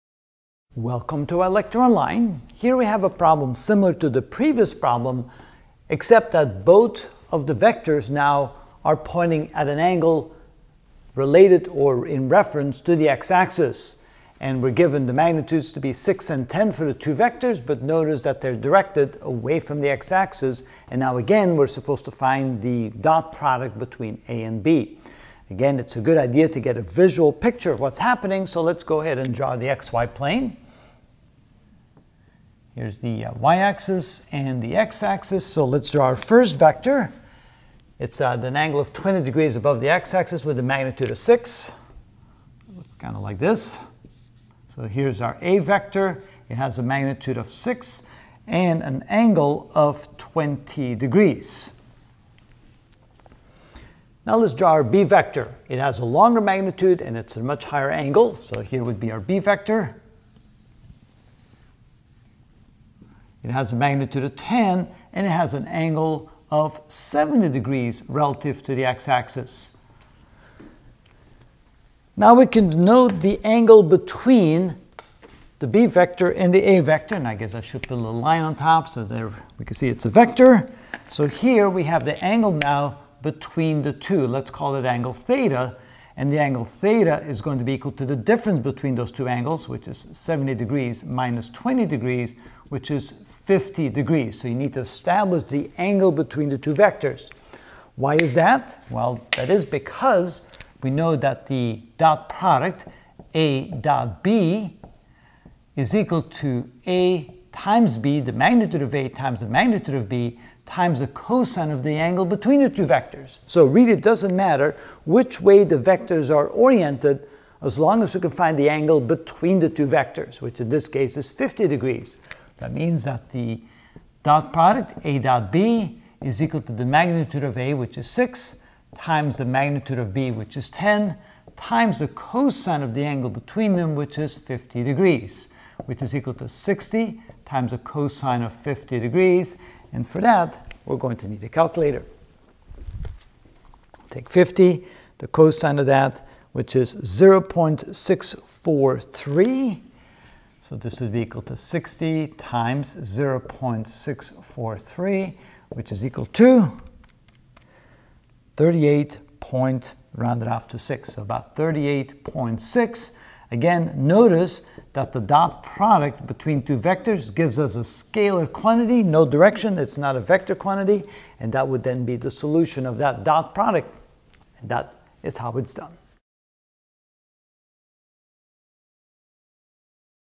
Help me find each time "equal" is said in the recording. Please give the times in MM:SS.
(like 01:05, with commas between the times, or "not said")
01:27, 01:45, 02:06, 02:16, 02:31, 02:36.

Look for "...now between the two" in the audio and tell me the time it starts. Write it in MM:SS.
01:22.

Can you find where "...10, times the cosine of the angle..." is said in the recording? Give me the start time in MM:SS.
02:10.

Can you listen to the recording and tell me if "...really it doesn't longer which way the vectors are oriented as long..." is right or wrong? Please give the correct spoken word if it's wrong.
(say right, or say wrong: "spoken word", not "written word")
wrong: "matter", not "longer".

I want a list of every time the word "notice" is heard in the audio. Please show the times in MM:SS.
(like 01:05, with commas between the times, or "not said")
00:17, 02:43.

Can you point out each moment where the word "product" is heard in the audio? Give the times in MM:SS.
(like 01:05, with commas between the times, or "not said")
00:23, 01:42, 02:04, 02:45, 02:53.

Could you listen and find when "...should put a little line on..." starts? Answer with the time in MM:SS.
01:17.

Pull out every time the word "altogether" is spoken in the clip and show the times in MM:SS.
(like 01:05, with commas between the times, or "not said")
not said.